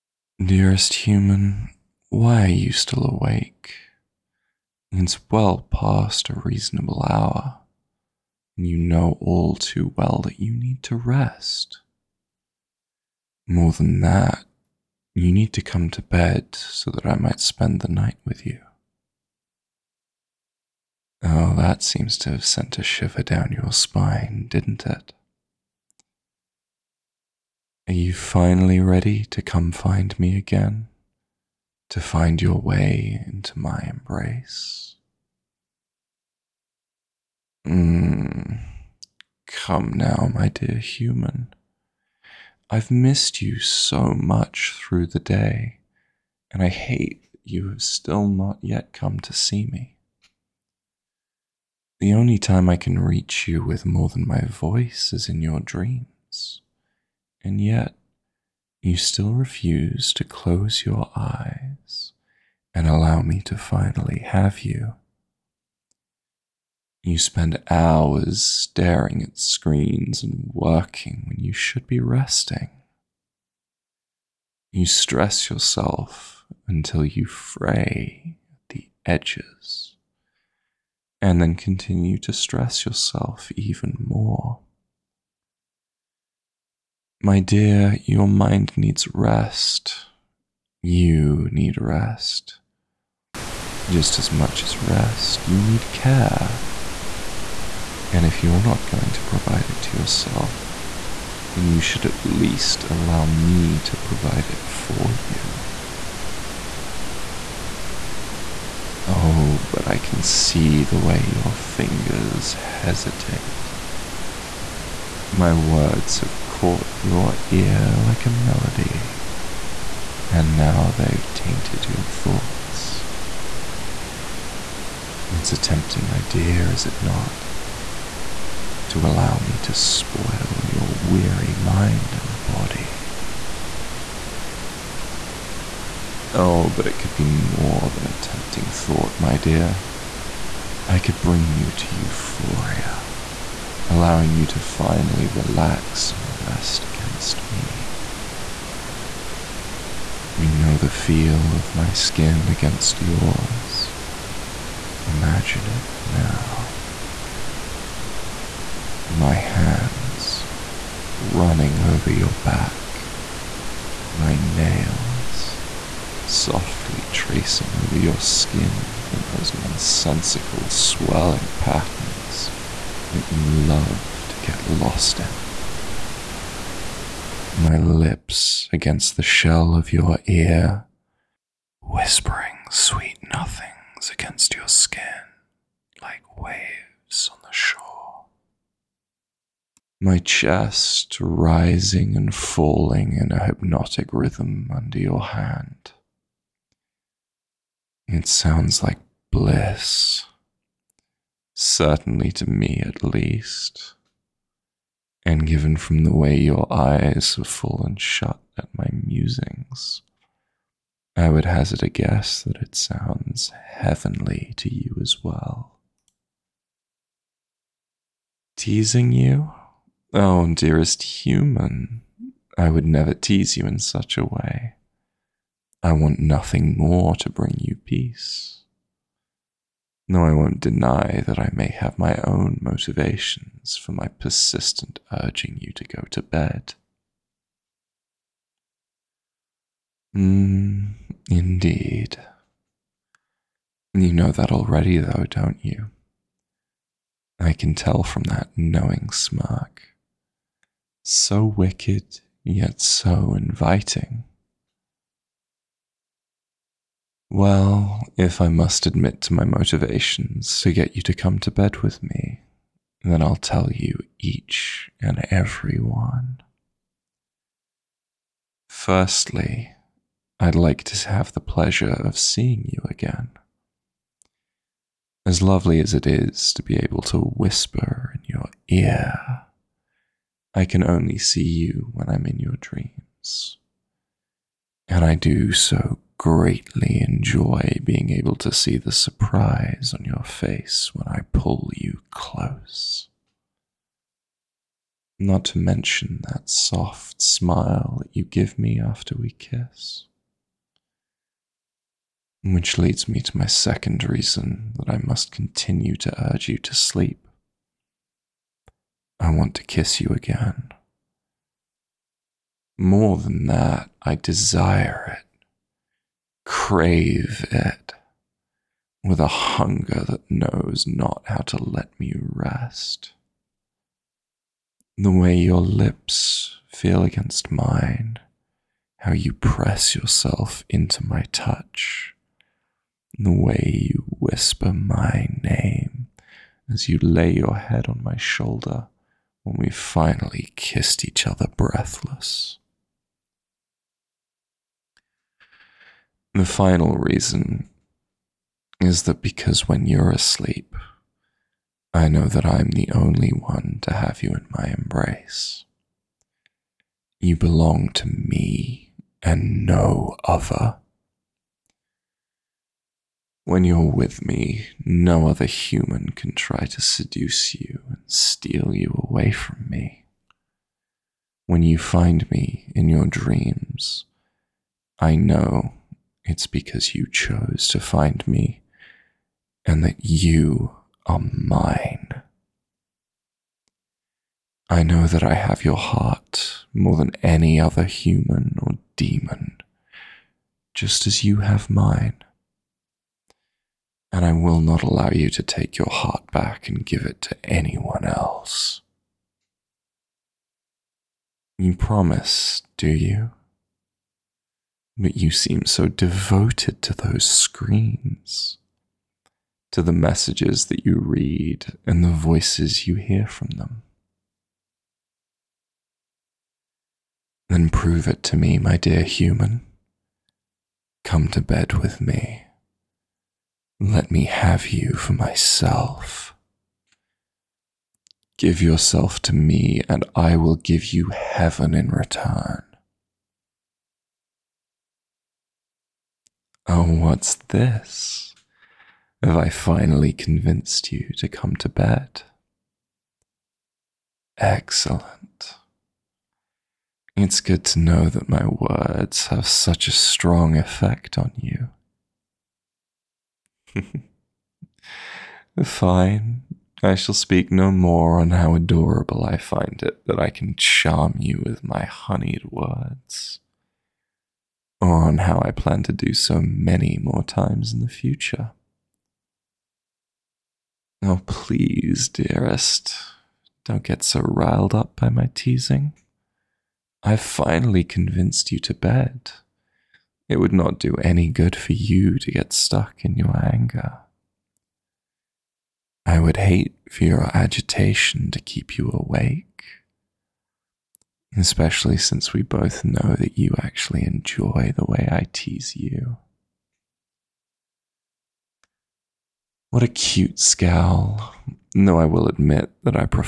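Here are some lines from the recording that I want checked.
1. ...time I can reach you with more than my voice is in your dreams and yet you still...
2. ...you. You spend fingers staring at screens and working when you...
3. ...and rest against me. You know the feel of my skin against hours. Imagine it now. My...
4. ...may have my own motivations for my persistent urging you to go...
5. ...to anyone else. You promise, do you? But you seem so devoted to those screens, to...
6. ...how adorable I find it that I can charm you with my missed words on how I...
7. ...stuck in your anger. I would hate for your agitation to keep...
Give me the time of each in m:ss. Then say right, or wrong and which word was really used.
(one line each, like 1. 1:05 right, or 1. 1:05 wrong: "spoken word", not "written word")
1. 0:52 right
2. 1:04 wrong: "hours", not "fingers"
3. 2:26 wrong: "yours", not "hours"
4. 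3:51 right
5. 6:37 right
6. 7:38 wrong: "honeyed", not "missed"
7. 8:02 right.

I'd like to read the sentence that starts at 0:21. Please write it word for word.
Oh, that seems to have sent a shiver down your spine, didn't it?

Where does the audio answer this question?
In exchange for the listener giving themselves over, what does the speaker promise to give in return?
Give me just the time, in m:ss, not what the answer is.
7:11.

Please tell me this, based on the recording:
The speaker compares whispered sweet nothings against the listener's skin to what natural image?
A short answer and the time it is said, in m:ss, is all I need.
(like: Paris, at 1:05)
Waves on the shore, at 3:06.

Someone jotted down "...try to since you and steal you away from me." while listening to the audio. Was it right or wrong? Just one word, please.
wrong.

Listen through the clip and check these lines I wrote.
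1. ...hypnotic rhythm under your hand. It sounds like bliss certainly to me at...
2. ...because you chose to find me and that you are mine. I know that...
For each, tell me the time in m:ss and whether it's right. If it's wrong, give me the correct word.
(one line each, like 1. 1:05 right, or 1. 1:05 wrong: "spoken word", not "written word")
1. 3:13 right
2. 6:16 right.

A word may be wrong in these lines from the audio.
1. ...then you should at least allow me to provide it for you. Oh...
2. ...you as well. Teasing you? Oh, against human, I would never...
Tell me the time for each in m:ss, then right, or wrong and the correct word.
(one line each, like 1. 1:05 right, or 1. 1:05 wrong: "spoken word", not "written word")
1. 1:41 right
2. 3:34 wrong: "dearest", not "against".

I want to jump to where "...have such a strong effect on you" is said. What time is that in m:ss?
7:29.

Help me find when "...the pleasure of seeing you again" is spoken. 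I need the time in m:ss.
4:31.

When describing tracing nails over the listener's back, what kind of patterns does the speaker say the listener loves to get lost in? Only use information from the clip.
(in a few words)
Nonsensical swelling patterns.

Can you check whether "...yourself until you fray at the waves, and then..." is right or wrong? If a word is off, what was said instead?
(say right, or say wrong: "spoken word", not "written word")
wrong: "edges", not "waves".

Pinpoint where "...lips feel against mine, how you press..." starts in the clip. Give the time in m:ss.
5:25.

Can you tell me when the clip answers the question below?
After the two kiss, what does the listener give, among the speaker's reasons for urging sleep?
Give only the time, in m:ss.
4:56.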